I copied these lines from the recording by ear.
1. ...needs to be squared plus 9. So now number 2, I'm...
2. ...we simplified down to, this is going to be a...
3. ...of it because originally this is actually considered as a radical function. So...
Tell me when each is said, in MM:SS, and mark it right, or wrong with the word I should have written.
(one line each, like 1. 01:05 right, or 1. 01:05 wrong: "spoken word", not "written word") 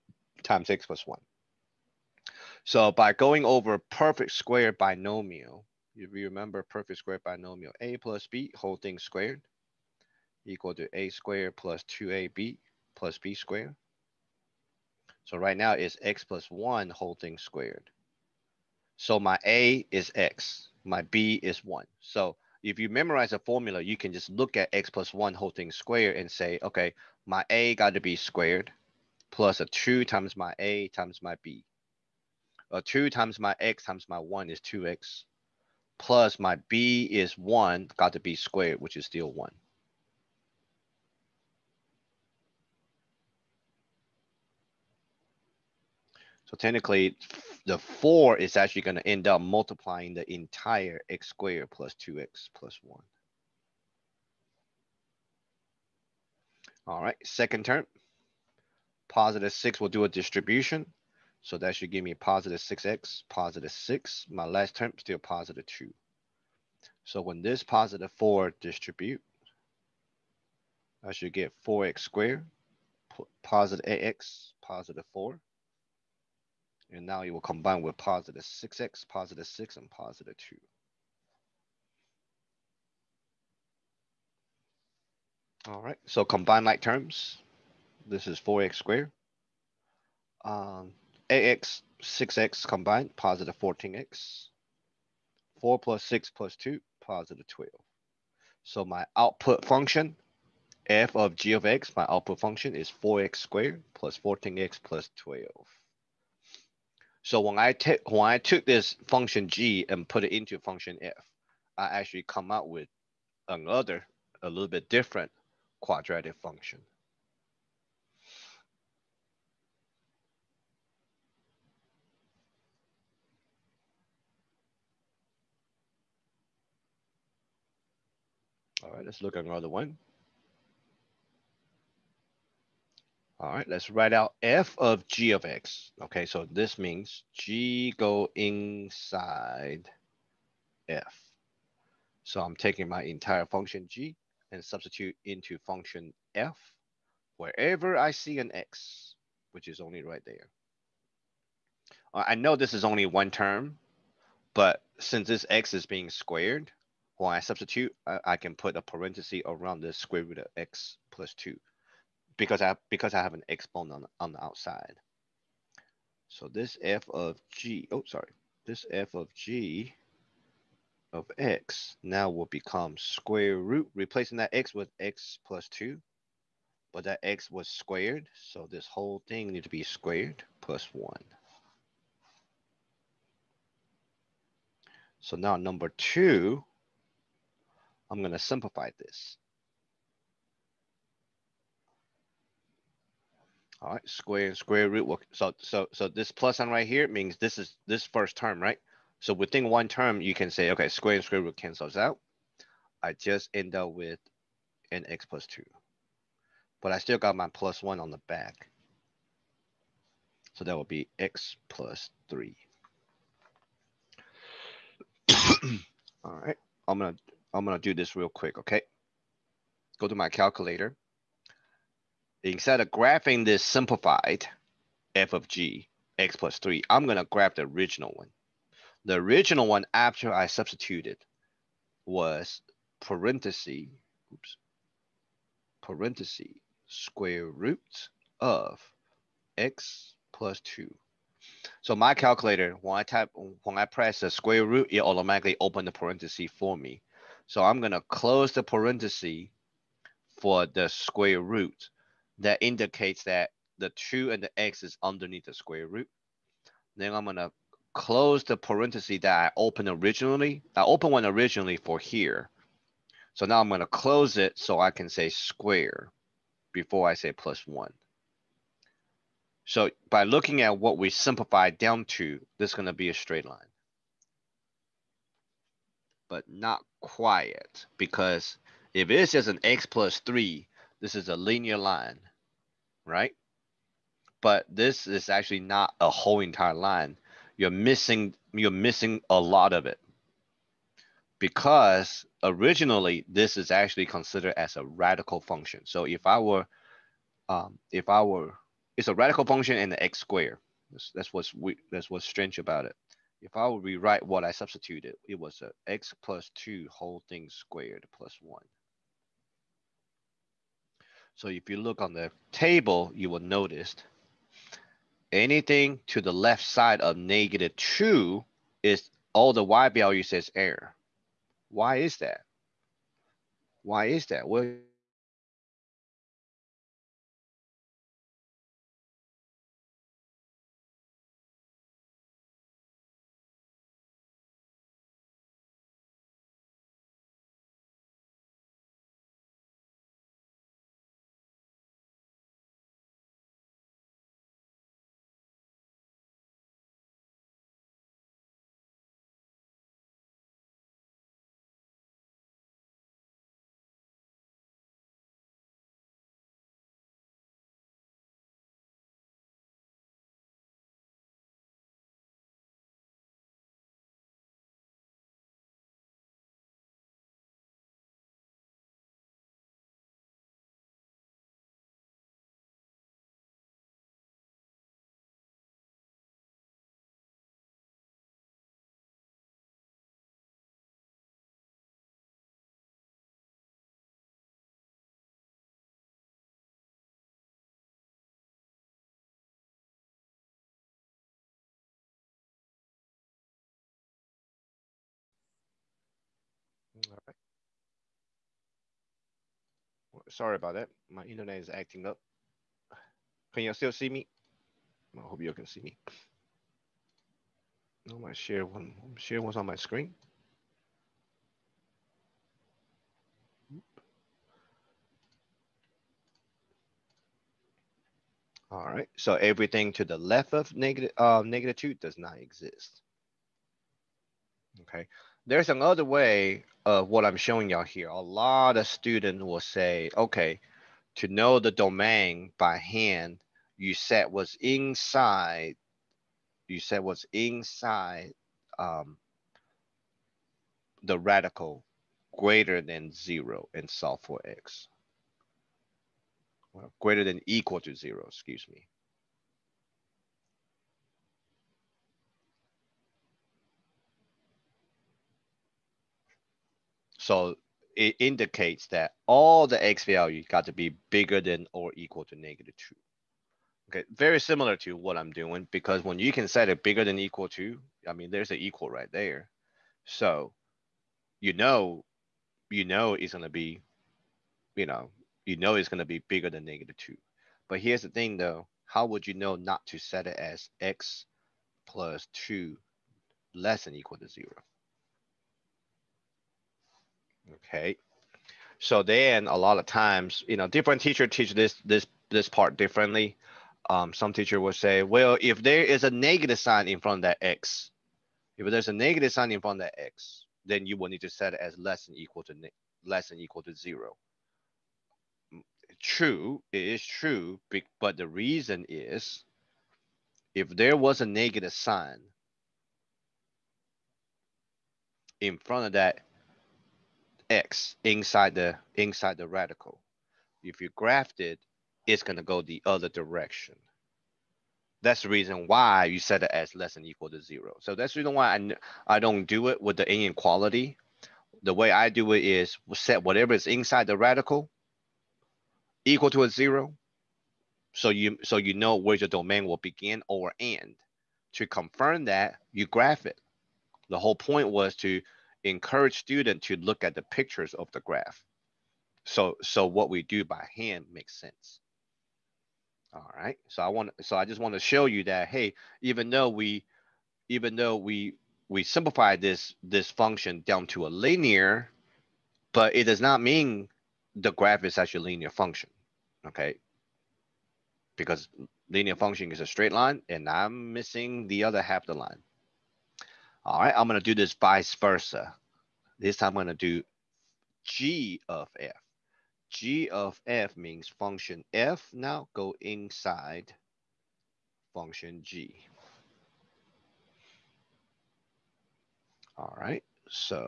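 1. 02:59 wrong: "1", not "9"
2. 04:30 right
3. 04:49 right.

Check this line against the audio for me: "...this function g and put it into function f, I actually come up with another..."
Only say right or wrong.
right.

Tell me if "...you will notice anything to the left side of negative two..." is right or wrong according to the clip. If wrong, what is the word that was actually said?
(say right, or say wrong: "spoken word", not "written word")
right.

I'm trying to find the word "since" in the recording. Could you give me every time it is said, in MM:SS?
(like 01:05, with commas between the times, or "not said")
02:34.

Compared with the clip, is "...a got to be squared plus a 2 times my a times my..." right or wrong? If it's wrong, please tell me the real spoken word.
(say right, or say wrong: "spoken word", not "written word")
right.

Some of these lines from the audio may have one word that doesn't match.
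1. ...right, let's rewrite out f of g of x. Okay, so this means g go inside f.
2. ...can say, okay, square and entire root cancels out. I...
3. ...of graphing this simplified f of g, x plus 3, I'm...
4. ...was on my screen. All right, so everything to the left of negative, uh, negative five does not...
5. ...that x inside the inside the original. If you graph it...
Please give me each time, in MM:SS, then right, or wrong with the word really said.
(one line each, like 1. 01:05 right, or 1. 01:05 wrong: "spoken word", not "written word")
1. 02:13 wrong: "write", not "rewrite"
2. 03:20 wrong: "square", not "entire"
3. 03:42 right
4. 06:49 wrong: "two", not "five"
5. 08:35 wrong: "radical", not "original".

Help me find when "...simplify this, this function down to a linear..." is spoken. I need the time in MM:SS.
09:18.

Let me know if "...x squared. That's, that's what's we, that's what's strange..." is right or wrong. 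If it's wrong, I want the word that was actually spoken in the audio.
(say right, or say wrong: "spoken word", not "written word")
right.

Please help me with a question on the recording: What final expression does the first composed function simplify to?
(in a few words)
4x squared plus 14x plus 12.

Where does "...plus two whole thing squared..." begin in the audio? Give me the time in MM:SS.
05:06.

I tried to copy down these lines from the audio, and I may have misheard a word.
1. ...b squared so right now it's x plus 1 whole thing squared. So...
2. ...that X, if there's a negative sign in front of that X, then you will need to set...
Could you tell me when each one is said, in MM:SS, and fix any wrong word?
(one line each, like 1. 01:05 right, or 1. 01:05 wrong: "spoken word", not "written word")
1. 00:13 right
2. 08:17 right.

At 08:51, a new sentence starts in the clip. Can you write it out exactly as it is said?
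The way I do it is set whatever is inside the radical equal to a zero.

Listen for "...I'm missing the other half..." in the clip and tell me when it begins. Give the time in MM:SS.
09:30.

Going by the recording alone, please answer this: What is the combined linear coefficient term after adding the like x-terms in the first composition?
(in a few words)
14x.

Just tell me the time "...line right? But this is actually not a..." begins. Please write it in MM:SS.
04:41.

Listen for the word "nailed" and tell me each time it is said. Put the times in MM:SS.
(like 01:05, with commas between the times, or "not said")
not said.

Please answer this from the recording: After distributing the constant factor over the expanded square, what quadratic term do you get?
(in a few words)
4x squared.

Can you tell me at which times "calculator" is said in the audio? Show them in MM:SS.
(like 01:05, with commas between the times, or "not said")
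03:40, 04:02.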